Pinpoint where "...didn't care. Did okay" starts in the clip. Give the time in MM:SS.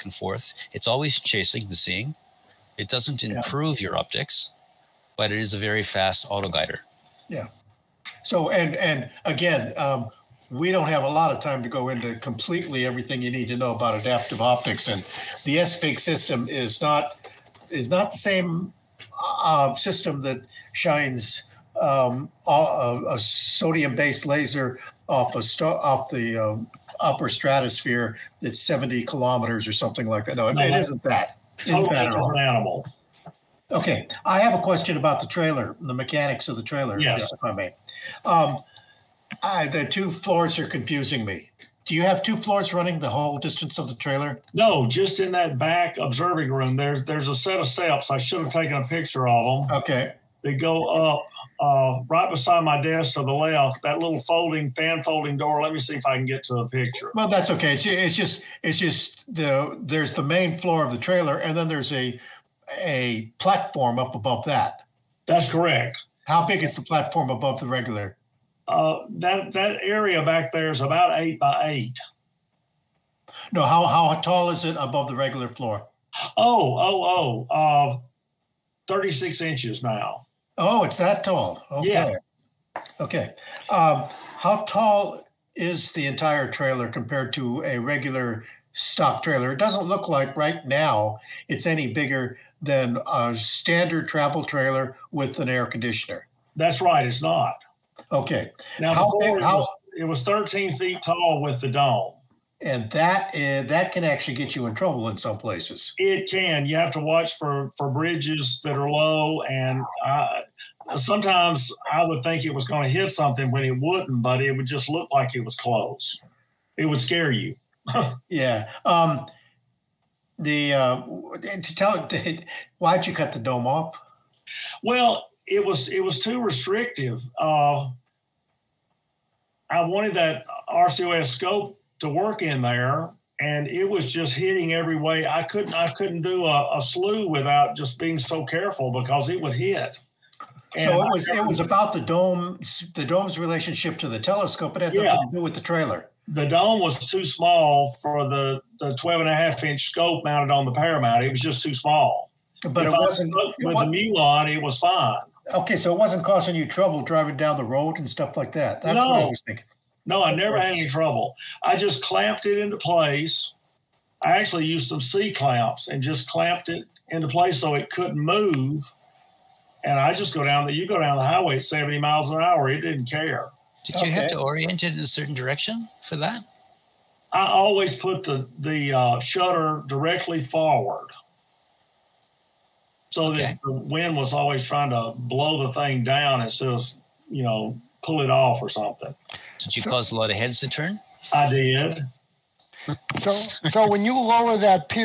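02:52.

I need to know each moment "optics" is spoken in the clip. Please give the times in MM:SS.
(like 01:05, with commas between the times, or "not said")
00:03, 00:14.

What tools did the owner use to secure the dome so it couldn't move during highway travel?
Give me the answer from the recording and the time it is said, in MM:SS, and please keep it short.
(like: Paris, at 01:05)
C clamps, at 02:45.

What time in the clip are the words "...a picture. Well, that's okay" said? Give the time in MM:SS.
00:56.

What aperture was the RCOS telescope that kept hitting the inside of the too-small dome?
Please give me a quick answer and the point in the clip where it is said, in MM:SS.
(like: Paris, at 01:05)
12.5 inch, at 02:28.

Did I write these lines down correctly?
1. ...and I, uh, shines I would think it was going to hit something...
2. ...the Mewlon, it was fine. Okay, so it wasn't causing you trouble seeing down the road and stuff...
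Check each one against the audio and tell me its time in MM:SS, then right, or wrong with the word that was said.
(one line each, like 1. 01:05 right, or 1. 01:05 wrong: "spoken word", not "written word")
1. 01:49 wrong: "sometimes", not "shines"
2. 02:33 wrong: "driving", not "seeing".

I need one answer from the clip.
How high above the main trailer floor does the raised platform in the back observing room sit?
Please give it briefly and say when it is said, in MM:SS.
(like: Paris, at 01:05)
36 inches, at 01:18.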